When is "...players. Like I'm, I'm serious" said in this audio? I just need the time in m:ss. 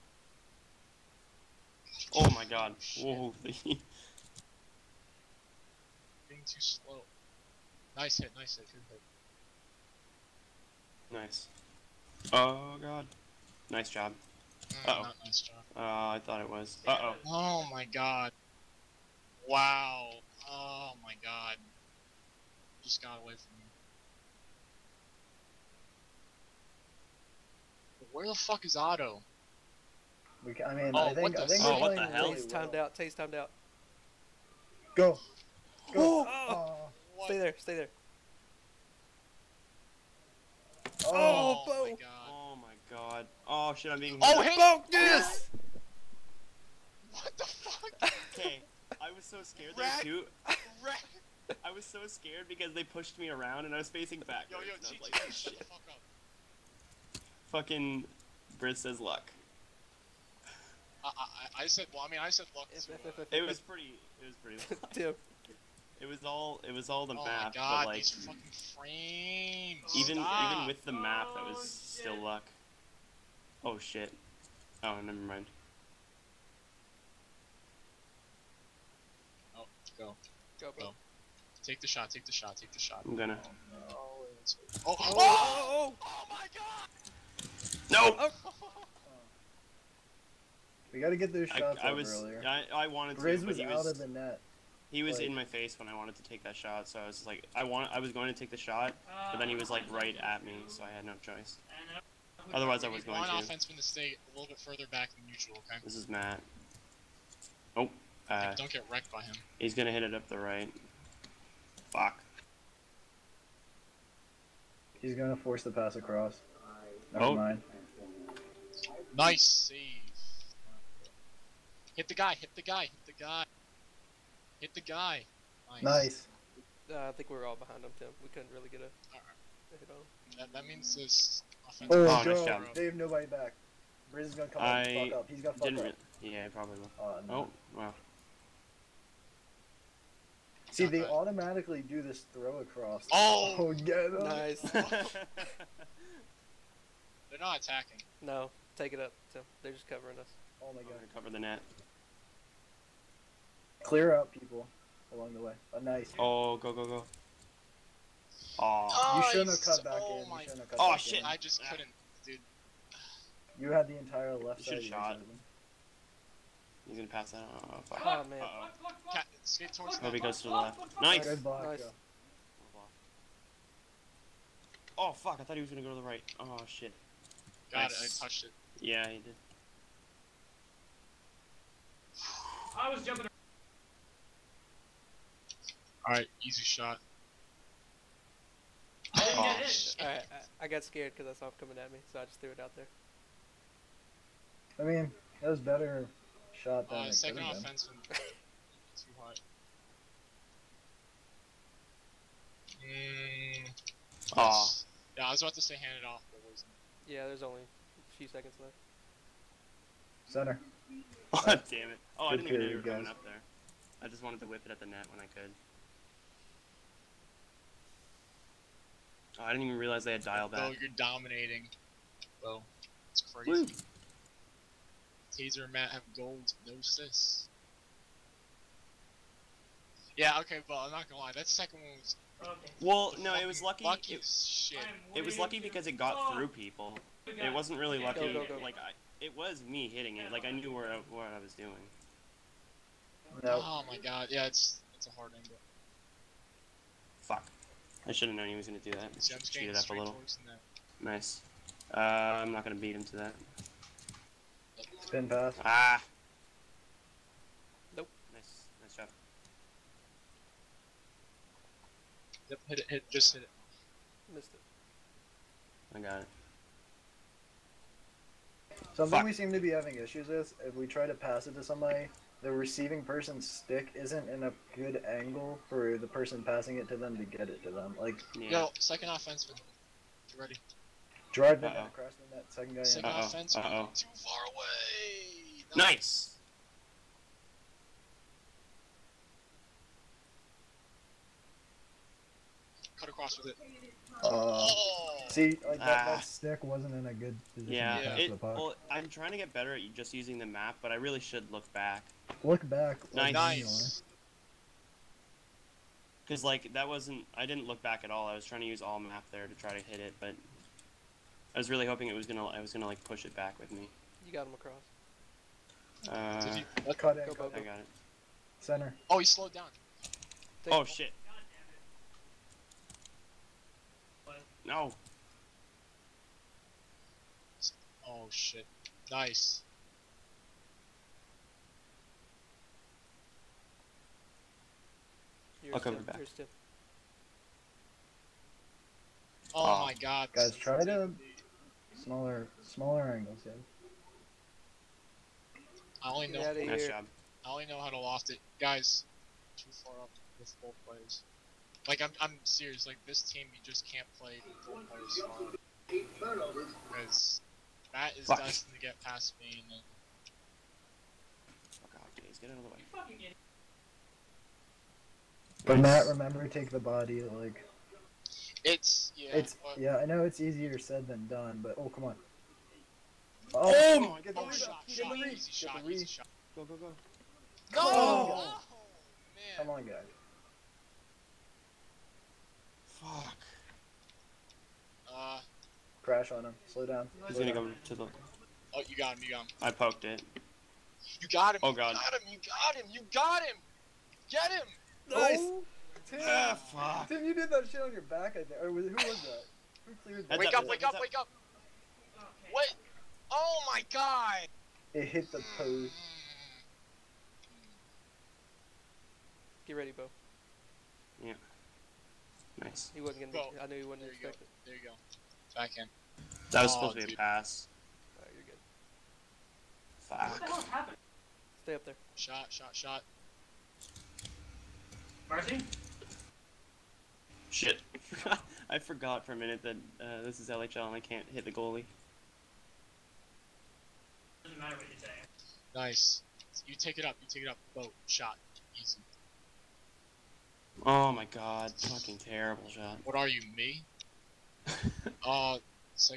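5:50.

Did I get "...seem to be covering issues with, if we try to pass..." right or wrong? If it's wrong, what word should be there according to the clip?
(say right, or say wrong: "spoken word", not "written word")
wrong: "having", not "covering".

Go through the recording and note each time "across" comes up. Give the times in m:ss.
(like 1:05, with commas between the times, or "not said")
1:55, 2:22, 4:53, 5:14.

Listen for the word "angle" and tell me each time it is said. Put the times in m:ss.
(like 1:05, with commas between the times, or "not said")
4:05, 4:35, 5:43.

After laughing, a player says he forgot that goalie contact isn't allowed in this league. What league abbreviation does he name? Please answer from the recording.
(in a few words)
LHL.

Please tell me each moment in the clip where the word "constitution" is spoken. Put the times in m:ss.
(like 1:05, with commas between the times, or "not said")
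not said.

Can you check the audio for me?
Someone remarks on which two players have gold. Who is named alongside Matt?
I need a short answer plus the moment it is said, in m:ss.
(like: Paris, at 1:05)
Taser, at 3:45.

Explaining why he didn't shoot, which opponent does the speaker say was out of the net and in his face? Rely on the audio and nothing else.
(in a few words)
Grizz.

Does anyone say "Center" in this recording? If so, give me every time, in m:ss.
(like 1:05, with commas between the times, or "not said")
3:30, 5:18.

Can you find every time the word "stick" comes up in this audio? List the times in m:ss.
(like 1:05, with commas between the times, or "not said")
4:33, 4:56.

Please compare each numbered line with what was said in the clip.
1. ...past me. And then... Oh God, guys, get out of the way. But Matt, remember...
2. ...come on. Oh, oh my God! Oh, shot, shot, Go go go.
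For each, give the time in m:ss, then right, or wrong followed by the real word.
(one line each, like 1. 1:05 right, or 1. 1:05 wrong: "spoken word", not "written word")
1. 5:59 right
2. 6:11 right.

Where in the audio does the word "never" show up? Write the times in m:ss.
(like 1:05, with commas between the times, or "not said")
1:15, 1:57.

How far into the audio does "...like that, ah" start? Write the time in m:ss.
4:55.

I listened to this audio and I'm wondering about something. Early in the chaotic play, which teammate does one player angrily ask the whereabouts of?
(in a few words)
Otto.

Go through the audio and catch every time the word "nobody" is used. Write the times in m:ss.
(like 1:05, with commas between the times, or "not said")
2:12.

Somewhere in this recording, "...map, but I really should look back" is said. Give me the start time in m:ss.
5:00.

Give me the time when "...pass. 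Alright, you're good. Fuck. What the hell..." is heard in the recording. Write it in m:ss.
6:57.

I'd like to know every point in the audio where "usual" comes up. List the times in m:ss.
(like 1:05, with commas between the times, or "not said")
1:45.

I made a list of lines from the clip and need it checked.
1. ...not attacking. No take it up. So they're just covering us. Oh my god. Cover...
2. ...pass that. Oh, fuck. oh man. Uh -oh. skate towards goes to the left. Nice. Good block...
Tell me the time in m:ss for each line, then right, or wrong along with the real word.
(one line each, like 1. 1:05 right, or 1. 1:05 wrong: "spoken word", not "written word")
1. 2:27 right
2. 2:47 right.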